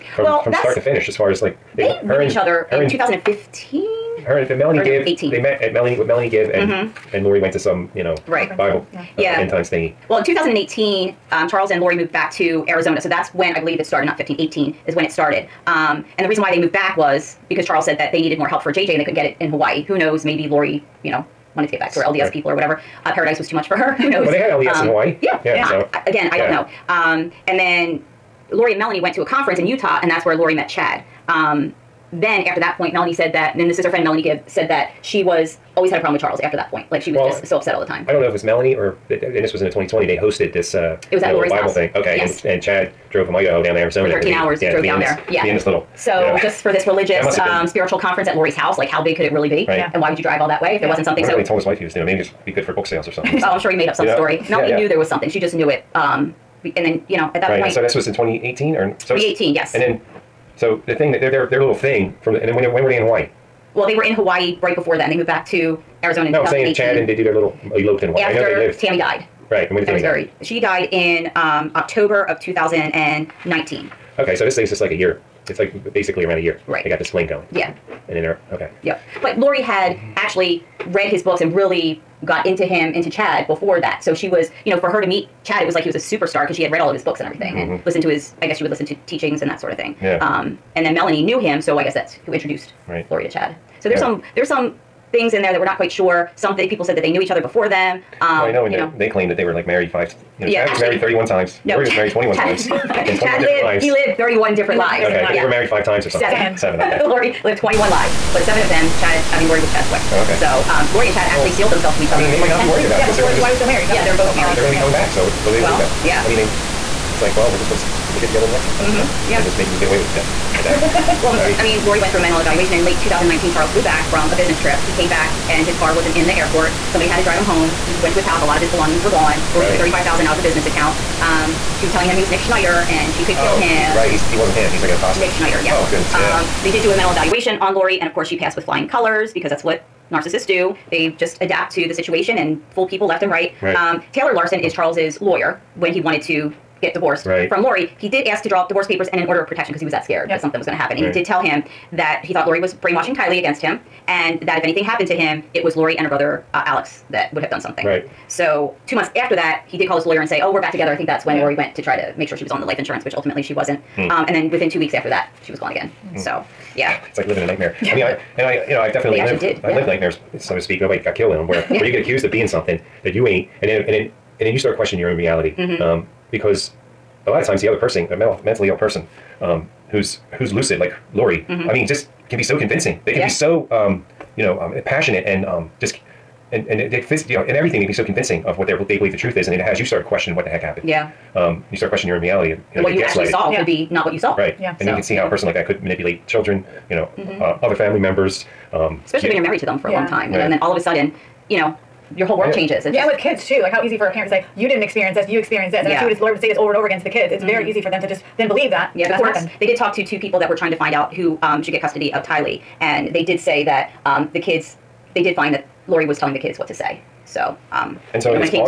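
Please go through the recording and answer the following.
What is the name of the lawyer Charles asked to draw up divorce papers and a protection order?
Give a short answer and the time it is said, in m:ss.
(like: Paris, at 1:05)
Taylor Larson, at 2:24.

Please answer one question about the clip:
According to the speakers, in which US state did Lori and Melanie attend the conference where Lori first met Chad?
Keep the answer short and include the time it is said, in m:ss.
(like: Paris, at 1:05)
Utah, at 0:29.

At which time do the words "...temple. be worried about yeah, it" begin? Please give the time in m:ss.
1:52.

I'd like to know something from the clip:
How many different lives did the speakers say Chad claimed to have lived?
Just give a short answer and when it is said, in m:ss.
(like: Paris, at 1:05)
31, at 1:44.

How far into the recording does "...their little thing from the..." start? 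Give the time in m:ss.
1:01.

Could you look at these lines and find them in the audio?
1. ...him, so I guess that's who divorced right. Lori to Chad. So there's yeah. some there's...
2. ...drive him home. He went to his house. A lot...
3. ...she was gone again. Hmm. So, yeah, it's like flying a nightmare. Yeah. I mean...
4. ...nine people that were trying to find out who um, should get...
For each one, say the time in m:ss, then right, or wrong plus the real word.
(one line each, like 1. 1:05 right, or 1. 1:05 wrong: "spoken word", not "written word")
1. 1:31 wrong: "introduced", not "divorced"
2. 2:07 right
3. 2:45 wrong: "living", not "flying"
4. 3:30 wrong: "two", not "nine".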